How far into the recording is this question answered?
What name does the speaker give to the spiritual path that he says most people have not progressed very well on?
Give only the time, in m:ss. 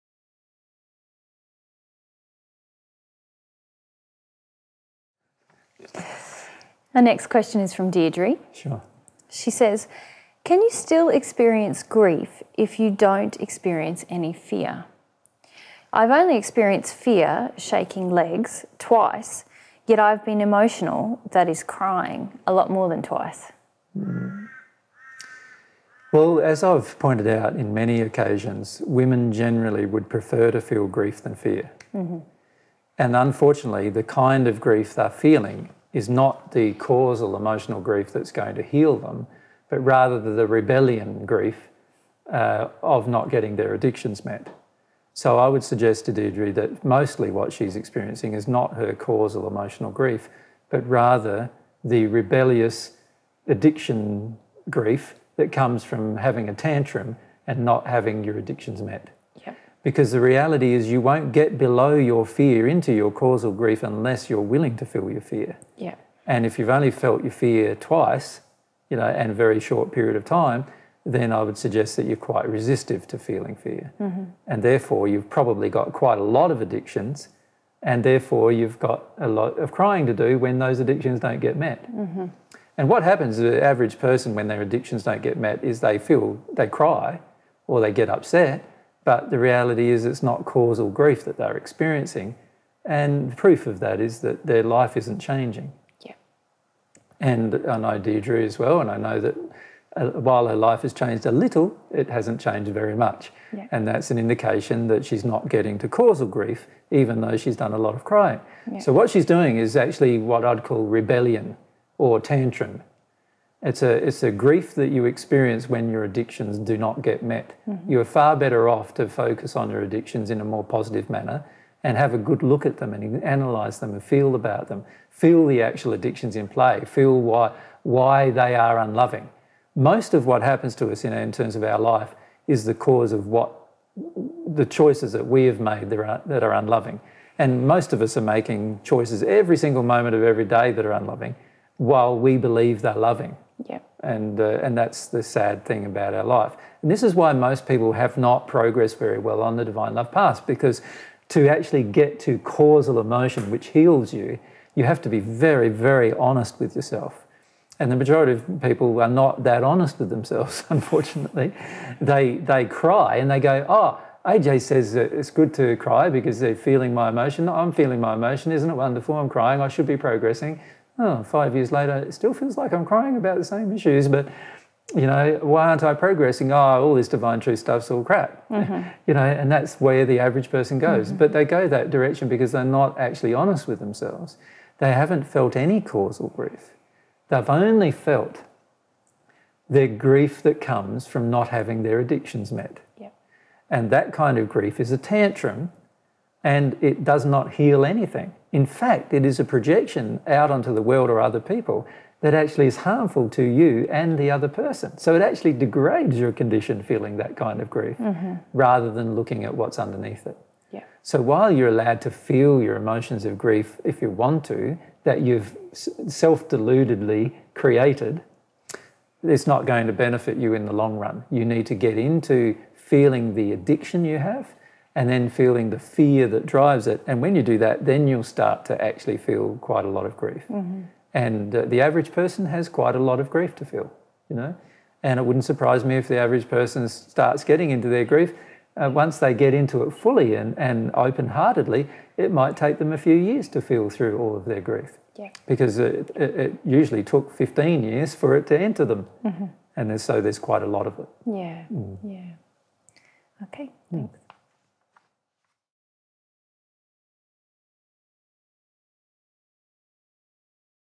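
2:29.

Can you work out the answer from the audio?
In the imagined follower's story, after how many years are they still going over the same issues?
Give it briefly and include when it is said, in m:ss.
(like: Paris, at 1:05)
5, at 2:51.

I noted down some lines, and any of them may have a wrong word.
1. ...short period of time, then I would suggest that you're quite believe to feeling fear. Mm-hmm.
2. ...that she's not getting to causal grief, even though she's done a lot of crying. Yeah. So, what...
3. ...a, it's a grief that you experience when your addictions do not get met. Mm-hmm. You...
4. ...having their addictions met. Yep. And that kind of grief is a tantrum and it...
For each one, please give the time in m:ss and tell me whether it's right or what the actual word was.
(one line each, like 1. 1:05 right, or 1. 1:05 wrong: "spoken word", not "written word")
1. 1:09 wrong: "resistive", not "believe"
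2. 1:44 right
3. 1:53 right
4. 3:11 right.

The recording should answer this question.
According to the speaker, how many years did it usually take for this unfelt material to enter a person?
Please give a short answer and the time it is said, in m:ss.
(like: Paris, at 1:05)
15 years, at 4:07.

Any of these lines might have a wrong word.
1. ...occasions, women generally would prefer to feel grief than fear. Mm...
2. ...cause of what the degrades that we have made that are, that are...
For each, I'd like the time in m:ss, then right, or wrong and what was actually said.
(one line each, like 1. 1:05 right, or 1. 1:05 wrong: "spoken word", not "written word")
1. 0:28 right
2. 2:12 wrong: "choices", not "degrades".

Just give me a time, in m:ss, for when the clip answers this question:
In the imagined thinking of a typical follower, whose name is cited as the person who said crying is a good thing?
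2:44.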